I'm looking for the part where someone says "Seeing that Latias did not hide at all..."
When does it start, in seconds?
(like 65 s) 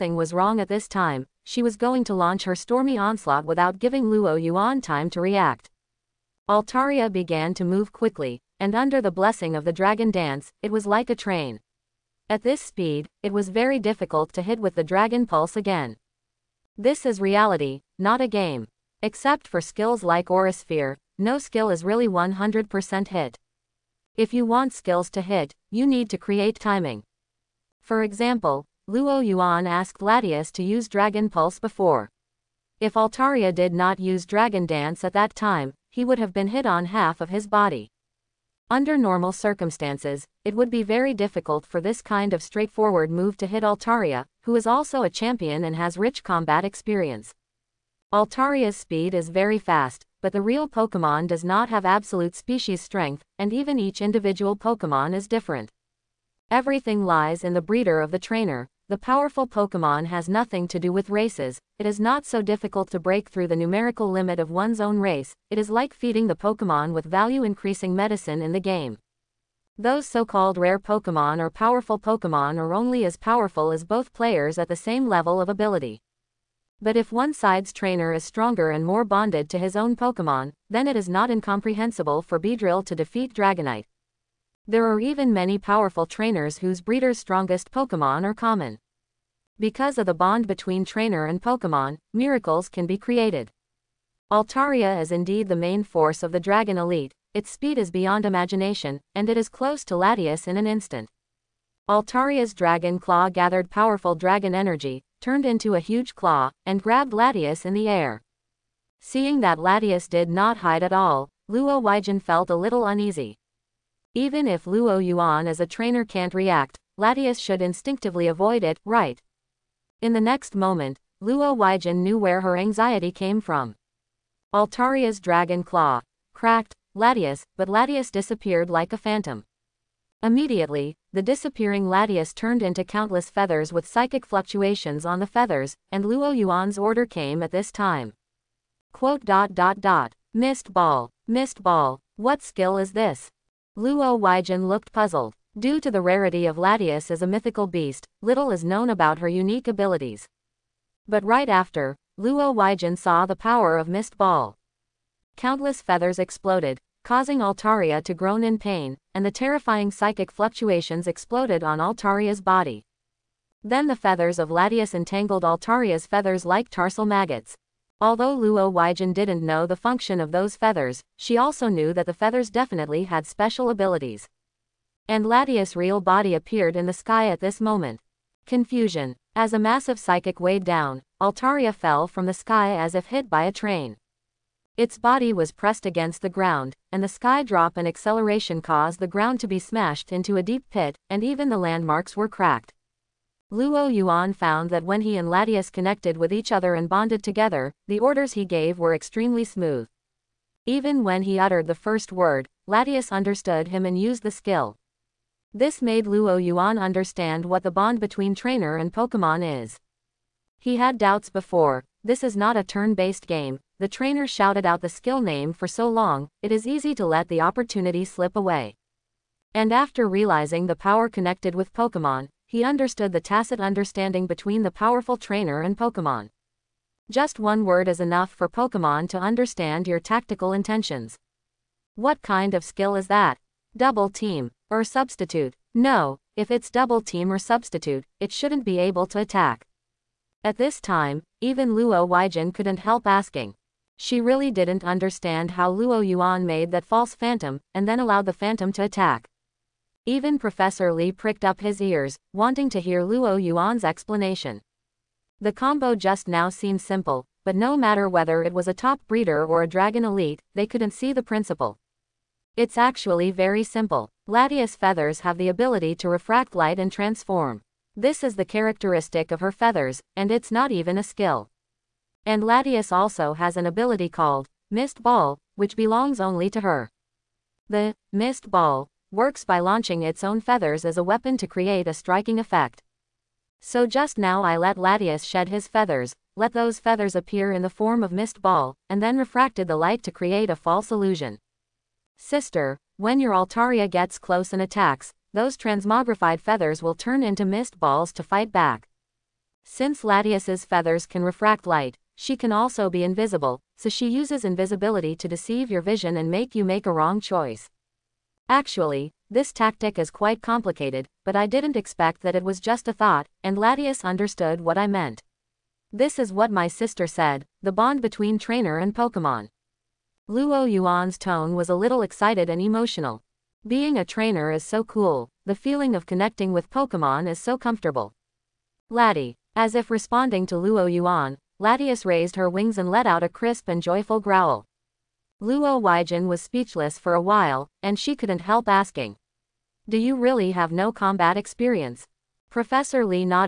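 108 s.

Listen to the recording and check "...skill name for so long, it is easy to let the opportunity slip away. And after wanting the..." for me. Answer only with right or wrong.
wrong.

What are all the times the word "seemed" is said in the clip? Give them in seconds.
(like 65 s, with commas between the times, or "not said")
256 s.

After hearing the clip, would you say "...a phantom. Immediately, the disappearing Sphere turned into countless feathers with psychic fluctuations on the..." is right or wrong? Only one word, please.
wrong.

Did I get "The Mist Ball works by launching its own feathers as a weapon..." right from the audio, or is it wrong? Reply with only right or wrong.
right.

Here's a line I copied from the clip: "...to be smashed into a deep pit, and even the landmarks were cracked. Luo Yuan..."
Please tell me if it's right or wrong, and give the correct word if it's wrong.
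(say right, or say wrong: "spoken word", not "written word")
right.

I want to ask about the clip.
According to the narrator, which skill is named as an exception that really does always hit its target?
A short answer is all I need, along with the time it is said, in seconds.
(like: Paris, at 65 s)
Aura Sphere, at 20 s.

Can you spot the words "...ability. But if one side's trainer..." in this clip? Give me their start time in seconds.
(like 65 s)
75 s.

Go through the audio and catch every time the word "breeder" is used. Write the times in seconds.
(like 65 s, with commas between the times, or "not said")
57 s, 86 s, 259 s.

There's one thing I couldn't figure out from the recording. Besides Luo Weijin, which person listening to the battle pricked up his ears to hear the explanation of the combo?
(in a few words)
Professor Li.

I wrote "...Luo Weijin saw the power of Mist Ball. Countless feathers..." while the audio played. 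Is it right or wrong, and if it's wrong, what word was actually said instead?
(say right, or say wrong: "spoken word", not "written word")
right.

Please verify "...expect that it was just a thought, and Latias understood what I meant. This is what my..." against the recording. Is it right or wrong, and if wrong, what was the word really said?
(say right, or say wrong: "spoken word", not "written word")
right.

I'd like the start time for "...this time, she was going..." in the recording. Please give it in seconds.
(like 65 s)
0 s.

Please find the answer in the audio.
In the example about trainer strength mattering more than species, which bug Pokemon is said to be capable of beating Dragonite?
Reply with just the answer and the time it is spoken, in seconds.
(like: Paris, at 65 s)
Beedrill, at 82 s.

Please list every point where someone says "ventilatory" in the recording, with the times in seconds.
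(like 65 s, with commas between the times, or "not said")
not said.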